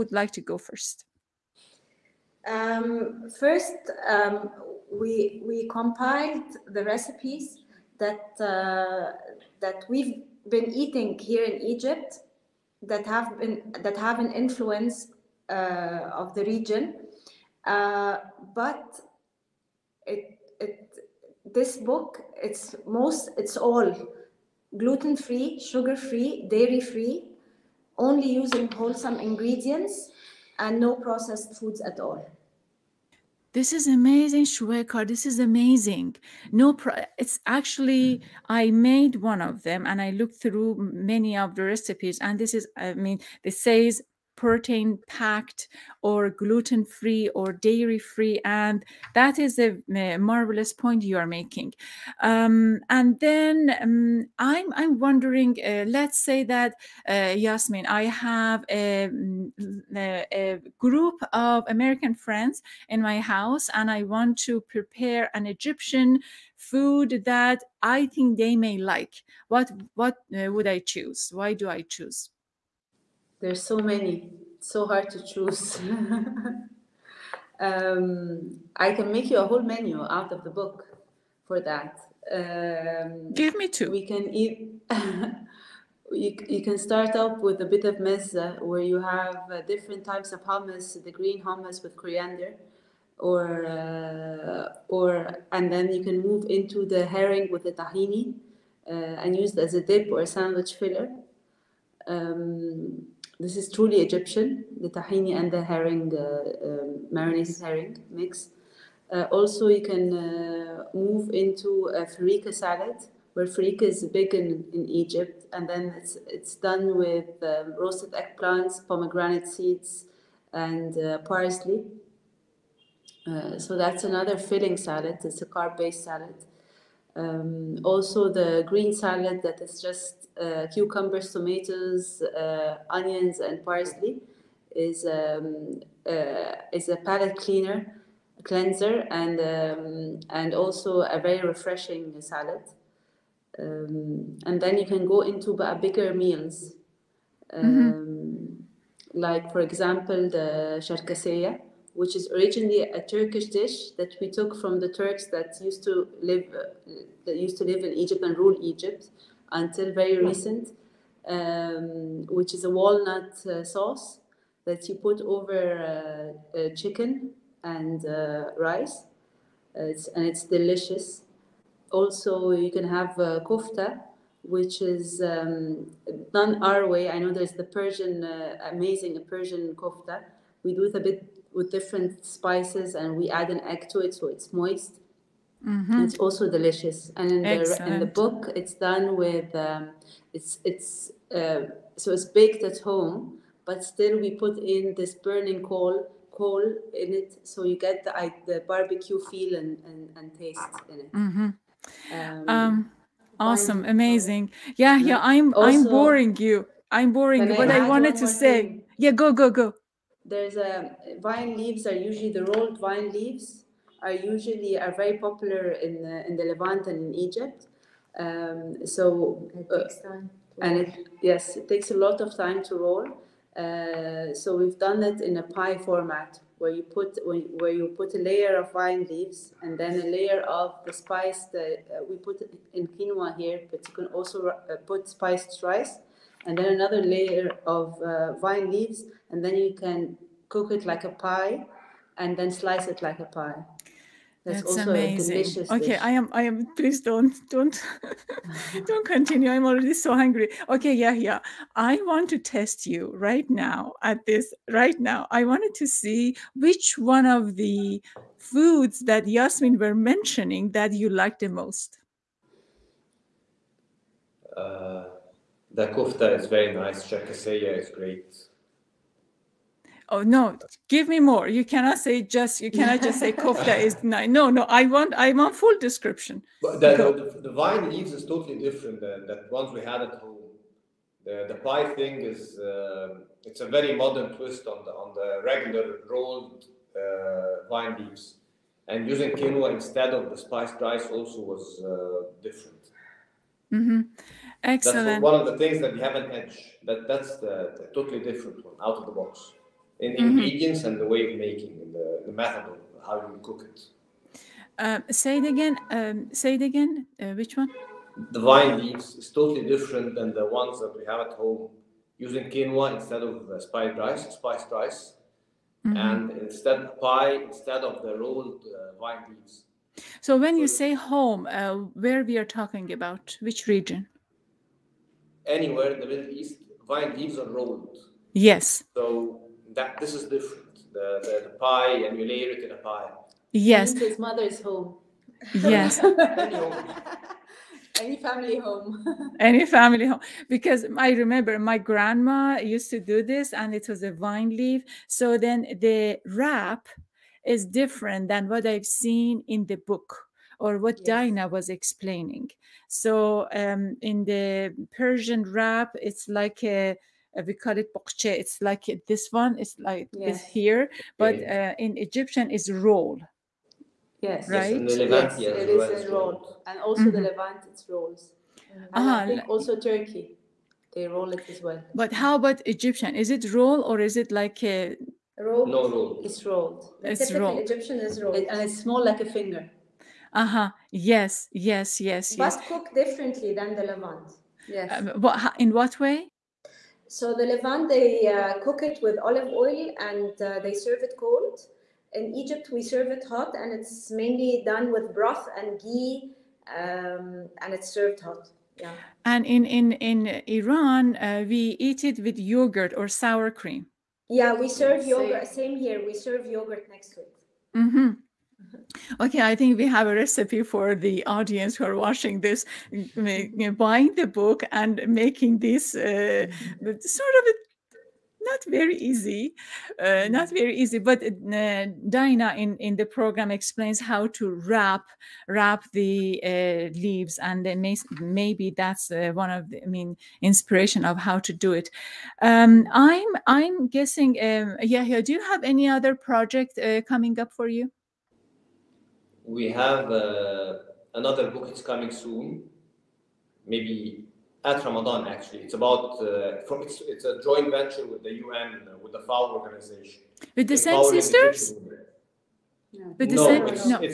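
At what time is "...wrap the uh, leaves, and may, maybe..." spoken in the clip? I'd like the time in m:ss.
7:05.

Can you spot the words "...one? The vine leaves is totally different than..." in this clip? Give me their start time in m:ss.
5:07.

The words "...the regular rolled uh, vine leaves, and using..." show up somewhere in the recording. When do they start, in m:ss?
4:45.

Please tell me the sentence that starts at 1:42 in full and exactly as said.
Um, this is truly Egyptian, the tahini and the herring, um, marinated herring mix.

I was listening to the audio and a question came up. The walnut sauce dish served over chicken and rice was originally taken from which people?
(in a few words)
The Turks.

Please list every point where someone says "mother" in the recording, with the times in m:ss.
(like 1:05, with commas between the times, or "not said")
5:34.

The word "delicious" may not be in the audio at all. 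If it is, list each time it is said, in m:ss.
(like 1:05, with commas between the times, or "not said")
2:50, 3:06, 4:05.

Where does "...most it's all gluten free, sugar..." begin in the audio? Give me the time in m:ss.
0:22.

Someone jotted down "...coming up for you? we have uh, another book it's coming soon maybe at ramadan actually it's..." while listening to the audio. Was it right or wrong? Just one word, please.
right.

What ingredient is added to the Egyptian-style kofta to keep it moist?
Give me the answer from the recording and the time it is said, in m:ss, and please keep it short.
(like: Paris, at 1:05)
An egg, at 3:03.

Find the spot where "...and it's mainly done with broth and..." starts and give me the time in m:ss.
6:33.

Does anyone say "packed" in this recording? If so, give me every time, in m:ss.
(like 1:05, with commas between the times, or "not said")
0:45.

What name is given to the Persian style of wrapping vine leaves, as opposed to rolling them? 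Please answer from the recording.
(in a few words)
Bokche.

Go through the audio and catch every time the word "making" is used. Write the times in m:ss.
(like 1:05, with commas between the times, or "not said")
0:51, 5:01, 6:55.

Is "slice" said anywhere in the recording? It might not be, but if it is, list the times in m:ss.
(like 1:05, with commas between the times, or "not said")
4:02.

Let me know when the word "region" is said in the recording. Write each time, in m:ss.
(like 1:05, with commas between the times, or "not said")
0:16, 5:23.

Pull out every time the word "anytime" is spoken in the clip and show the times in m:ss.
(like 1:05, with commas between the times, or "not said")
not said.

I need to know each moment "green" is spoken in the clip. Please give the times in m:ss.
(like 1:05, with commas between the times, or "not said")
1:31, 2:08.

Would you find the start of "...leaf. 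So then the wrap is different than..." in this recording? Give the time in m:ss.
5:44.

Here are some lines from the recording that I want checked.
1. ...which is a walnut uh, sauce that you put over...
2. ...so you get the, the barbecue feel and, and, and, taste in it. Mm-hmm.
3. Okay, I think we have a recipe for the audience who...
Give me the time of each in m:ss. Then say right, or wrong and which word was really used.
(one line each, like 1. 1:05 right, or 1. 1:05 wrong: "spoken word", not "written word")
1. 2:42 right
2. 3:17 right
3. 6:49 right.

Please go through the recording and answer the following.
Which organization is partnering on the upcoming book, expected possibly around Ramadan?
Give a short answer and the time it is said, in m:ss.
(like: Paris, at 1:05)
FAO, at 7:29.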